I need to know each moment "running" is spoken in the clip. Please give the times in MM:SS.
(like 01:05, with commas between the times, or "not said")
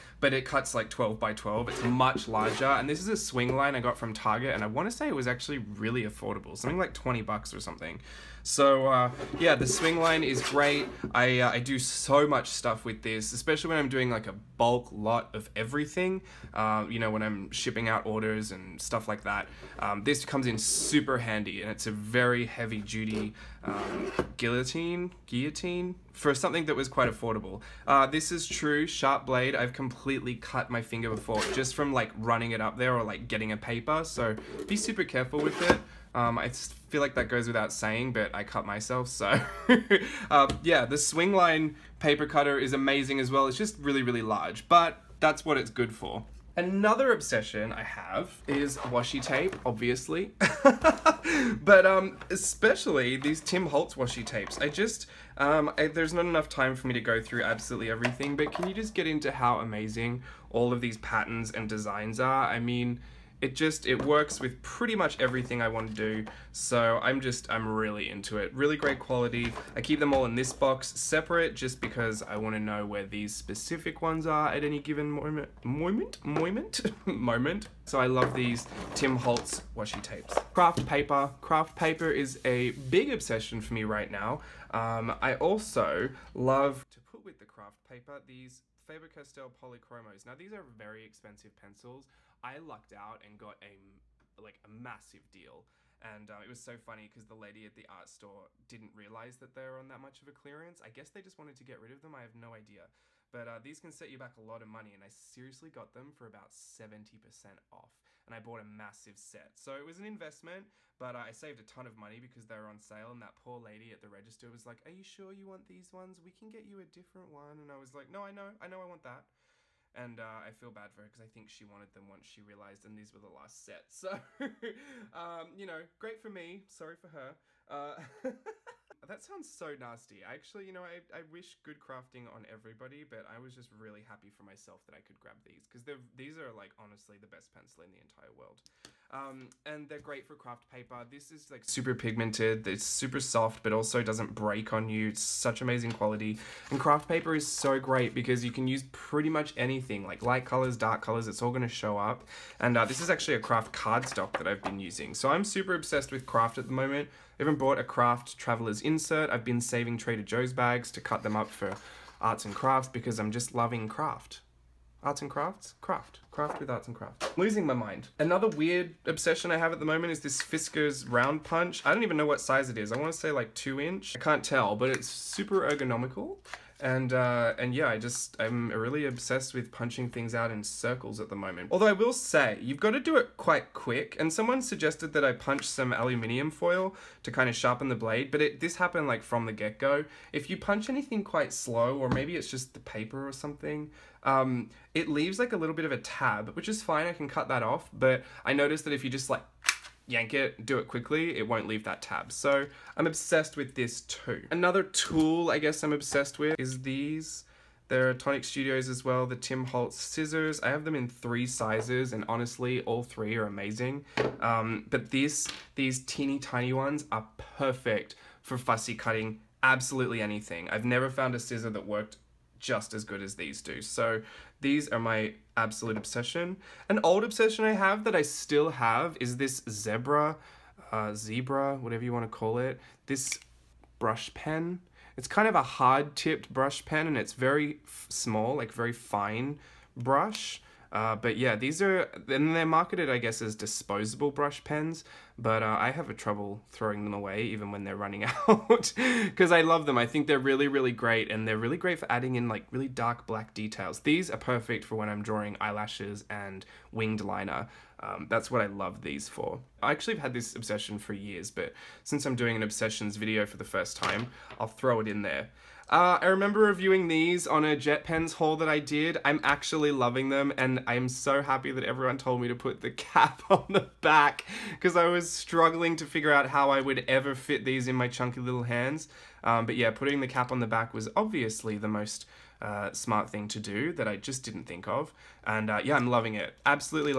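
00:32, 04:07.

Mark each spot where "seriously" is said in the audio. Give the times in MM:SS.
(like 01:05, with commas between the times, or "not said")
01:45.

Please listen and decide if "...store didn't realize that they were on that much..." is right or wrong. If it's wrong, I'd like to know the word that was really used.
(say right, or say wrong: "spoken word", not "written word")
right.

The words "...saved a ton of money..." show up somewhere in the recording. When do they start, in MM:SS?
01:51.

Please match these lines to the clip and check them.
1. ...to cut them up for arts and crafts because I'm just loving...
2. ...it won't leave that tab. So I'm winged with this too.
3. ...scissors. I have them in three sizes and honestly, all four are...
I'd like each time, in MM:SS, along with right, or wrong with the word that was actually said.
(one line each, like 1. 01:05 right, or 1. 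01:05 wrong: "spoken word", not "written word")
1. 02:40 right
2. 03:21 wrong: "obsessed", not "winged"
3. 03:29 wrong: "three", not "four".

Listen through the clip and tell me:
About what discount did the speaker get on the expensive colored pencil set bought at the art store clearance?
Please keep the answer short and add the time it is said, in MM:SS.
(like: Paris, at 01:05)
70%, at 01:46.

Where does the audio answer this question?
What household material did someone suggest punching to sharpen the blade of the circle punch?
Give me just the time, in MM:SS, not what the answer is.
03:05.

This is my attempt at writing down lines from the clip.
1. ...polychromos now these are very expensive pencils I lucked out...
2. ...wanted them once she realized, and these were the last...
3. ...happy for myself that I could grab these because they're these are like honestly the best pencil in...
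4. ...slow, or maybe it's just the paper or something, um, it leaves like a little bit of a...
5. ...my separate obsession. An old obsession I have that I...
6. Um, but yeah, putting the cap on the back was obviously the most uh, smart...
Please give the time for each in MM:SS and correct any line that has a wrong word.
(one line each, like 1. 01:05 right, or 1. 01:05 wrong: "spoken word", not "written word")
1. 01:29 right
2. 02:01 right
3. 02:14 right
4. 03:11 right
5. 03:44 wrong: "absolute", not "separate"
6. 04:39 right.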